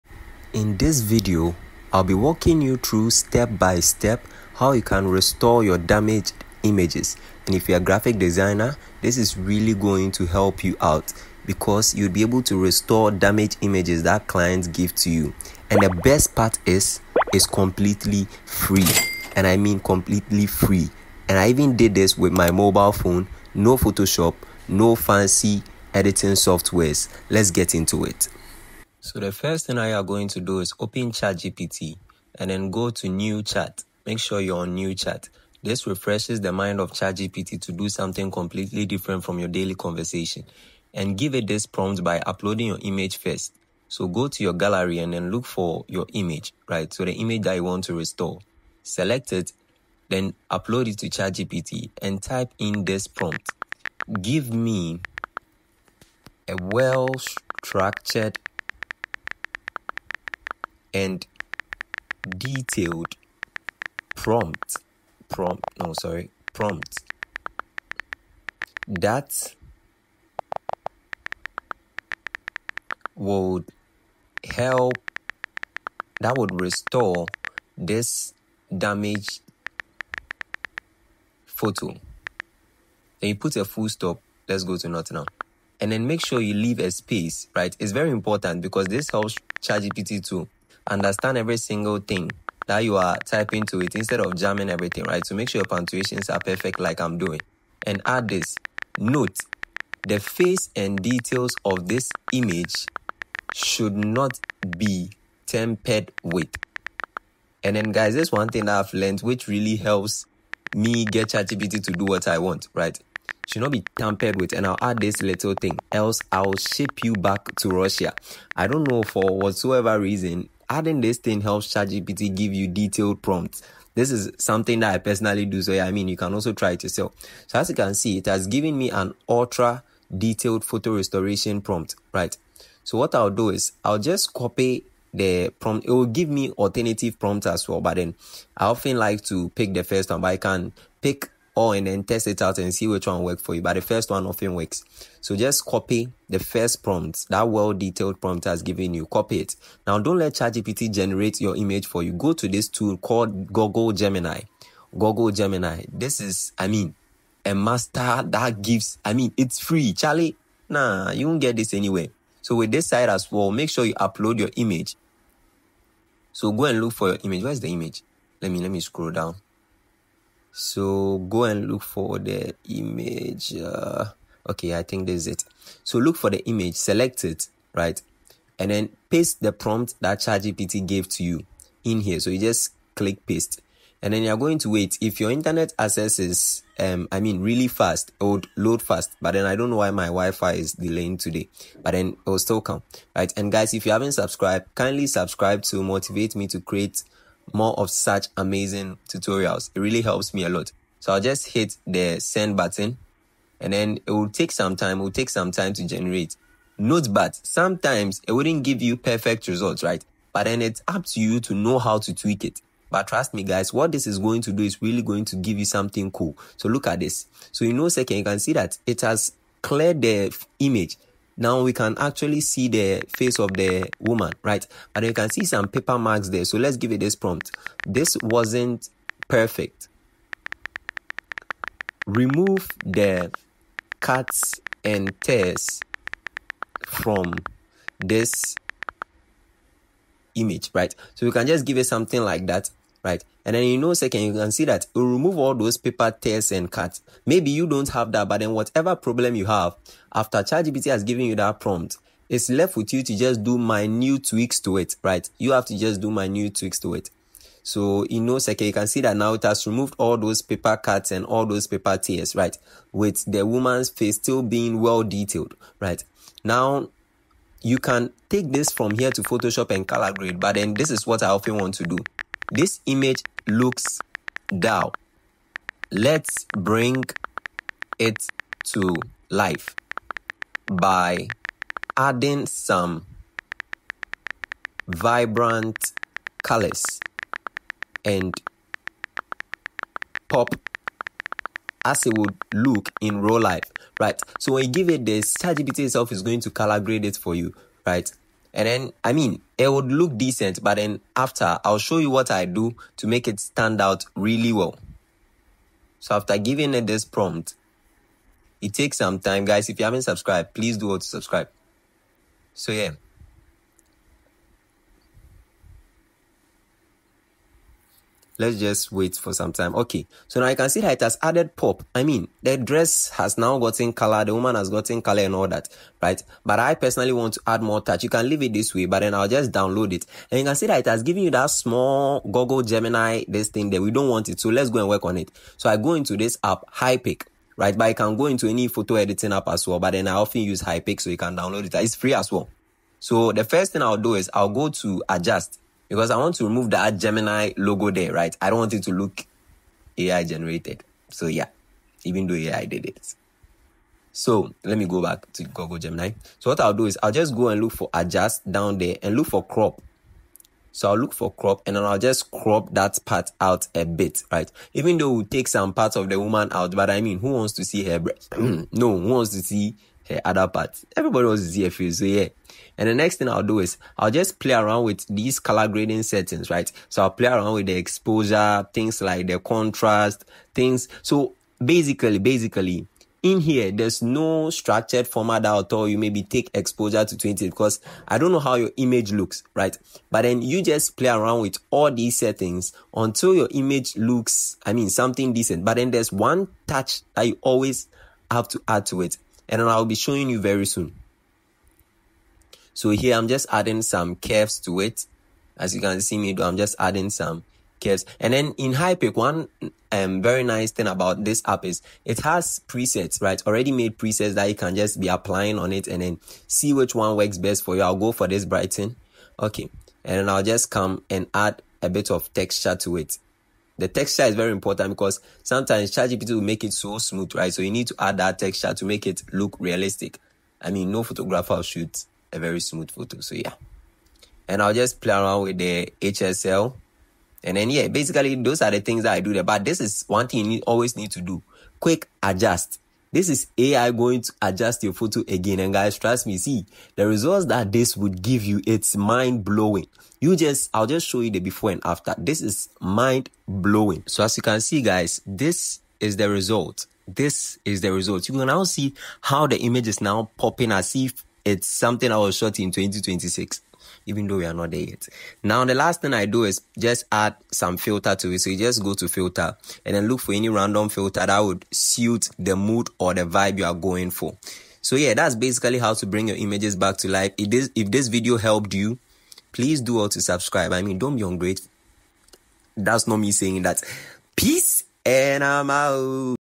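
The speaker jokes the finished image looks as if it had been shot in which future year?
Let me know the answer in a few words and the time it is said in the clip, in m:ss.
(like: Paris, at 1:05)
2026, at 7:42.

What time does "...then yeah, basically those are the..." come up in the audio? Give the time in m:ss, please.
7:17.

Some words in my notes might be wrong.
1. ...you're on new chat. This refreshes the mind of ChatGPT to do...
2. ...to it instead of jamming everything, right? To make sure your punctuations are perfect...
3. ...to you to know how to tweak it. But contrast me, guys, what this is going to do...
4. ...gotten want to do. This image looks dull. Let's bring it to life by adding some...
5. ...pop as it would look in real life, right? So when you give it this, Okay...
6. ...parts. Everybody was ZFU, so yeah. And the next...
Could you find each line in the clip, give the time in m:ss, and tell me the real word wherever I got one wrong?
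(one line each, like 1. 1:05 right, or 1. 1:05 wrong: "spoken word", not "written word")
1. 0:34 right
2. 1:33 right
3. 3:31 wrong: "trust", not "contrast"
4. 4:31 wrong: "often", not "gotten"
5. 4:50 wrong: "ChatGPT", not "Okay"
6. 6:10 right.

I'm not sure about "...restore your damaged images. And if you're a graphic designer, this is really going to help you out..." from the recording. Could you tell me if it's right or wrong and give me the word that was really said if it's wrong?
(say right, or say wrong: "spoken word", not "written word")
right.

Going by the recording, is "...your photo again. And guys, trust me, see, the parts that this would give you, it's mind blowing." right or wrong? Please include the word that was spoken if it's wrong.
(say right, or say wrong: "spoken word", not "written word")
wrong: "results", not "parts".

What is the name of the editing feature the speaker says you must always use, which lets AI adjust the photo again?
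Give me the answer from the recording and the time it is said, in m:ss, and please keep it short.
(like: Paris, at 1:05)
Quick adjust, at 7:21.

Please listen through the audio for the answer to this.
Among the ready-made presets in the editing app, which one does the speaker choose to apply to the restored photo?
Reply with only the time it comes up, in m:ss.
6:58.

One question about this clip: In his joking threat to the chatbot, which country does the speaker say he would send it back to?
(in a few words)
Russia.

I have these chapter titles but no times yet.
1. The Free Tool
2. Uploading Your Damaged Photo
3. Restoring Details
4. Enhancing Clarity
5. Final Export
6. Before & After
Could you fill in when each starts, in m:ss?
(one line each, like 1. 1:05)
1. 0:35
2. 1:10
3. 2:20
4. 3:40
5. 4:55
6. 6:00.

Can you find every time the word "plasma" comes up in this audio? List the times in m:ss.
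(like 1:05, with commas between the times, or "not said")
not said.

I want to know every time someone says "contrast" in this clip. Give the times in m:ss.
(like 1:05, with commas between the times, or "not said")
6:19.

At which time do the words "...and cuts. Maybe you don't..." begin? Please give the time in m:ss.
4:06.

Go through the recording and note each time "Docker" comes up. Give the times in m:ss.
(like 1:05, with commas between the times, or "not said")
not said.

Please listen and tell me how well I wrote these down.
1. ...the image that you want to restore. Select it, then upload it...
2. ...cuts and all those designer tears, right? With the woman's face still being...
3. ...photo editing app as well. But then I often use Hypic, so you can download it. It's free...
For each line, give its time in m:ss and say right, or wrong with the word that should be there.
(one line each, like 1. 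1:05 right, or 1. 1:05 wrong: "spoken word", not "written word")
1. 0:47 right
2. 4:20 wrong: "paper", not "designer"
3. 5:38 right.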